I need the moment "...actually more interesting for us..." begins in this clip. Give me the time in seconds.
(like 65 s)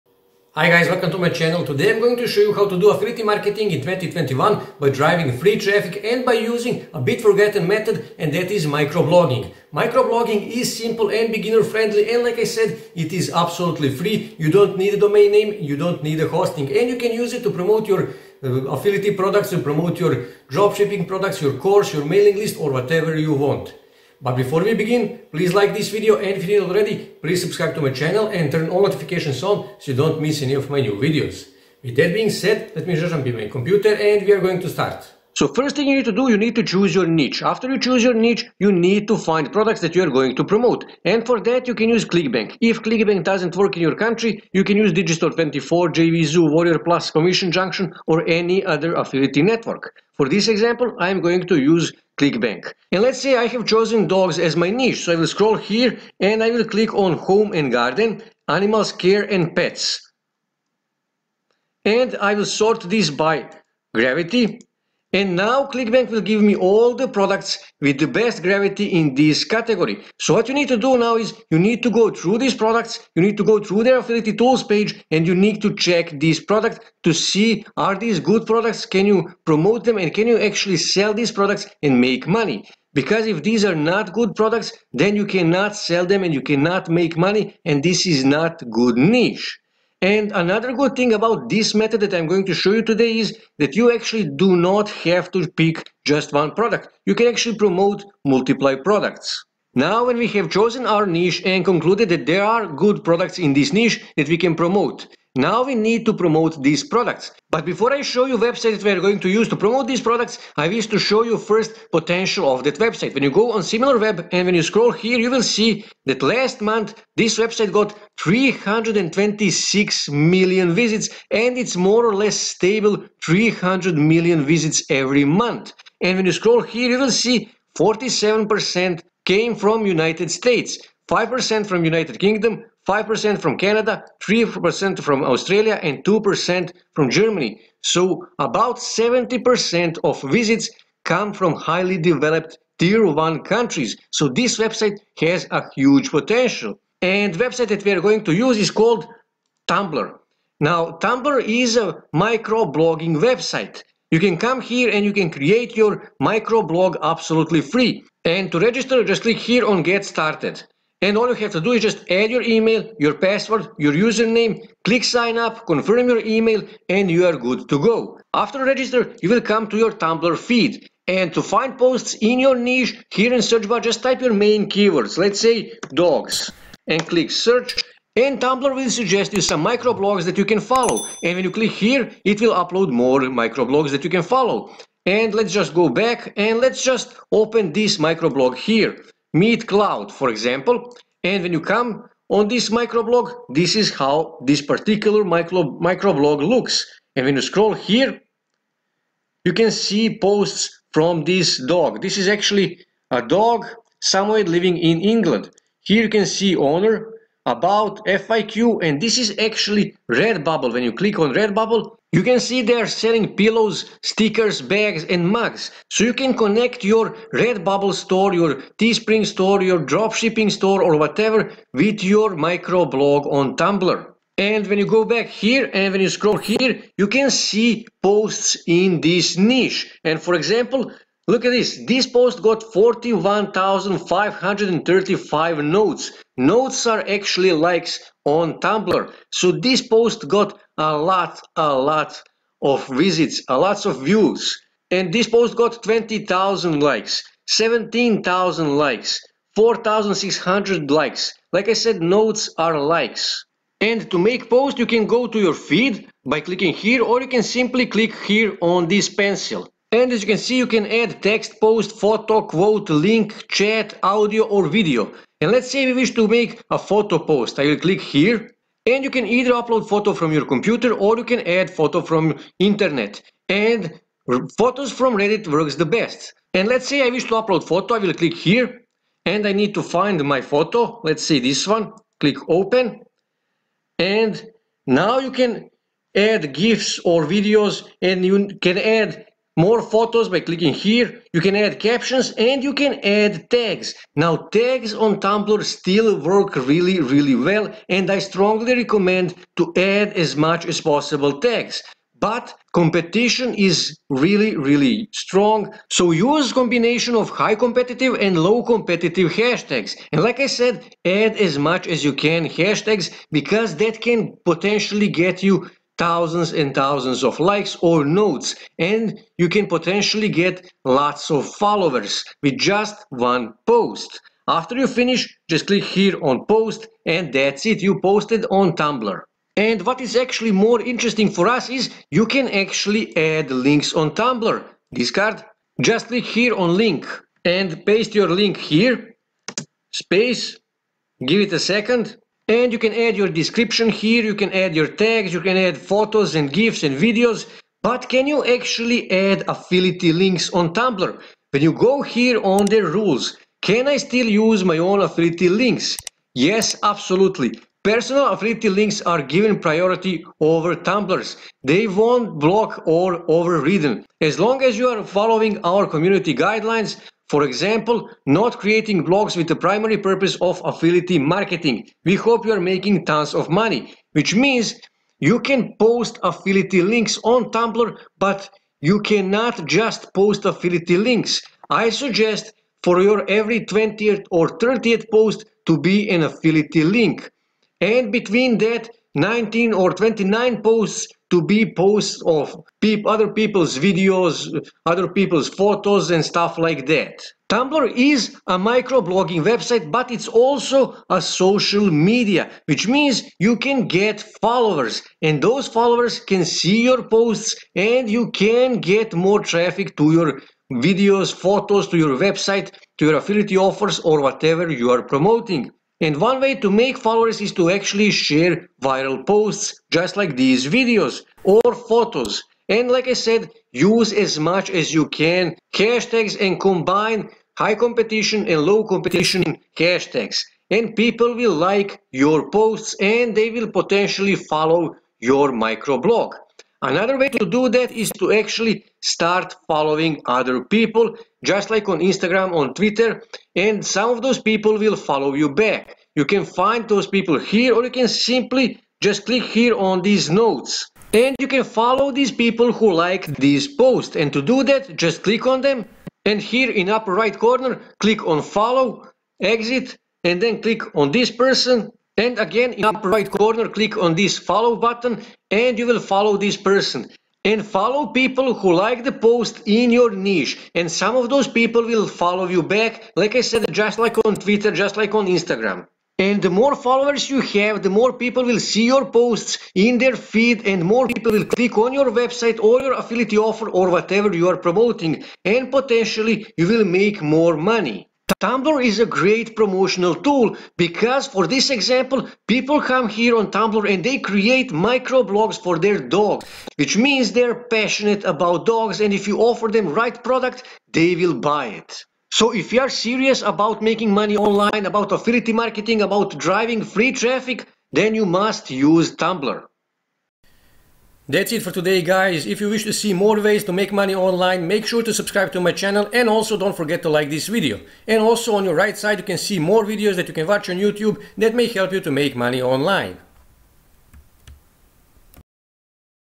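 330 s.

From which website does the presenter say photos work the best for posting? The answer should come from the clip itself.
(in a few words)
Reddit.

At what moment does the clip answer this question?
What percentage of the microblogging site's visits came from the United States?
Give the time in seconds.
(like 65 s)
127 s.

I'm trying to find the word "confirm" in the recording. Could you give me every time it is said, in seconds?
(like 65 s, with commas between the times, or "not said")
165 s.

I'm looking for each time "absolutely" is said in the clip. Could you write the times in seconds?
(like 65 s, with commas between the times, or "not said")
13 s, 157 s, 356 s.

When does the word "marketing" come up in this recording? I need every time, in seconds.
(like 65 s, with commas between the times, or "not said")
3 s, 371 s, 505 s.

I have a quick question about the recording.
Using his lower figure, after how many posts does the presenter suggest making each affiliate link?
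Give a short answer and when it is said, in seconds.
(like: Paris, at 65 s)
20th, at 383 s.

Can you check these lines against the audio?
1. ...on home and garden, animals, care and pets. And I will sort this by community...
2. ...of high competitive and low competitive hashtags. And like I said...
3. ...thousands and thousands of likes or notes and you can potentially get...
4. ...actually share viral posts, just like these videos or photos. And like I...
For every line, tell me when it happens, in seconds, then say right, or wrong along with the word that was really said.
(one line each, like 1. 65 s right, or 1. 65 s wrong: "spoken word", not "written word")
1. 56 s wrong: "gravity", not "community"
2. 307 s right
3. 316 s right
4. 417 s right.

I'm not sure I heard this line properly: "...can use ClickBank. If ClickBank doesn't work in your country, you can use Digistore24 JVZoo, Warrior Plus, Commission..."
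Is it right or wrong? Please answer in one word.
right.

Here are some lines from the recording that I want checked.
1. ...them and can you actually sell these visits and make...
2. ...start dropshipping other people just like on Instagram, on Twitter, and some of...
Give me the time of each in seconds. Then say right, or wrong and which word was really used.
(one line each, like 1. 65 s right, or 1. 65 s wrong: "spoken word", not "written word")
1. 79 s wrong: "products", not "visits"
2. 439 s wrong: "following", not "dropshipping".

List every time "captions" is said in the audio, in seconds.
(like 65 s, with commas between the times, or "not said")
291 s.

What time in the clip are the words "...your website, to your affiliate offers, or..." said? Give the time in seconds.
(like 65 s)
411 s.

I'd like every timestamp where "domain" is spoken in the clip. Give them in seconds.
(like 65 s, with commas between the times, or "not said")
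14 s.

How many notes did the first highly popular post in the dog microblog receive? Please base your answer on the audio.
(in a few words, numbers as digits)
41,535.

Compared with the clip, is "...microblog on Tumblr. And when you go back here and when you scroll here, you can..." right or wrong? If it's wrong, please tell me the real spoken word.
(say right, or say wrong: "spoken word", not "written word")
right.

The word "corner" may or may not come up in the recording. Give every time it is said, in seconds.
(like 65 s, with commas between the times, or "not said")
457 s, 463 s.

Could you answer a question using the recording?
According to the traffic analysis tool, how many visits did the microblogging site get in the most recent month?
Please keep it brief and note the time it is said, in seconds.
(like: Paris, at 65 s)
326 million, at 118 s.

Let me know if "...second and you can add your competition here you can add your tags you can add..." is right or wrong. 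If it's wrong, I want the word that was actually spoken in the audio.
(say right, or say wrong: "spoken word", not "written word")
wrong: "description", not "competition".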